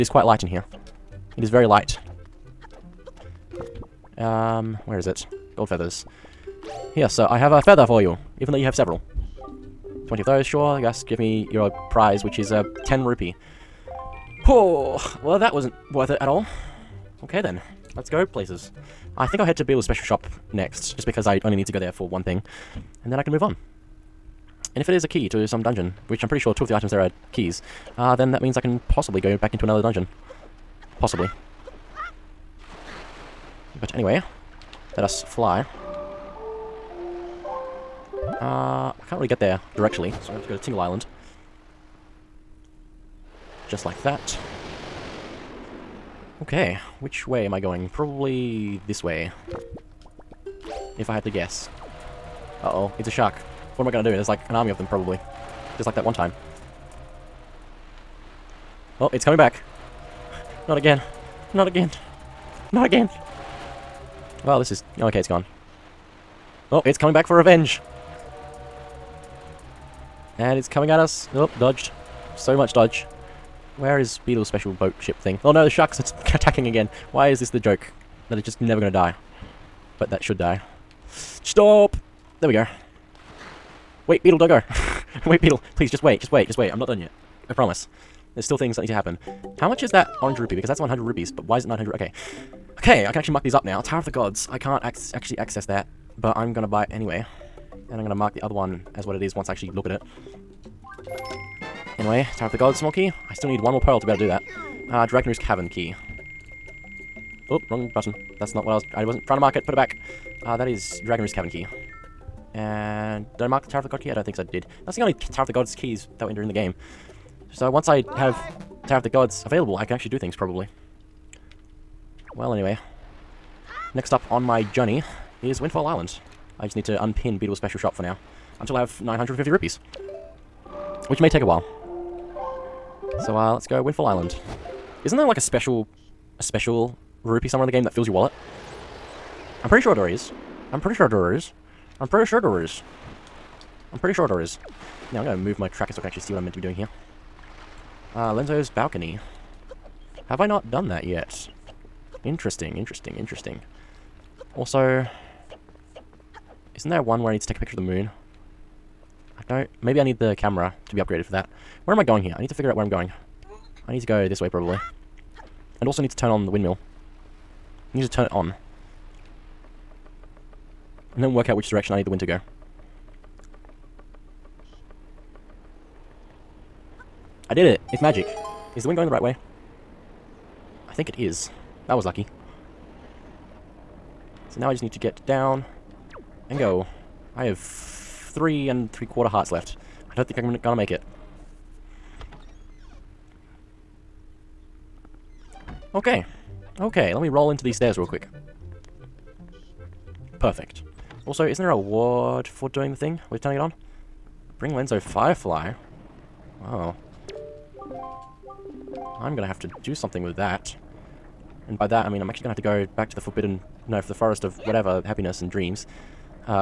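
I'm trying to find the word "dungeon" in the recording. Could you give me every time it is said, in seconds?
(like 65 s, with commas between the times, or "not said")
25 s, 29 s.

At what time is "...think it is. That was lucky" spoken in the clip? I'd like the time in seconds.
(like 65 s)
180 s.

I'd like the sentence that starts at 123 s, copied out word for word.
Next up on my journey is Windfall Island.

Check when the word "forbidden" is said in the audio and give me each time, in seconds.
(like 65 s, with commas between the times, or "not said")
213 s.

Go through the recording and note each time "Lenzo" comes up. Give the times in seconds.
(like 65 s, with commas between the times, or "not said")
148 s, 204 s.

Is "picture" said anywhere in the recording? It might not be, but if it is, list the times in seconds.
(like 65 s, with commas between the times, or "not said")
157 s.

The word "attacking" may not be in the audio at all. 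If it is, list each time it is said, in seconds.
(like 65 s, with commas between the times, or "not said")
76 s.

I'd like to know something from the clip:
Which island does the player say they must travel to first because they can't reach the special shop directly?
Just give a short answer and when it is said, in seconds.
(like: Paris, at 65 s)
Tingle Island, at 40 s.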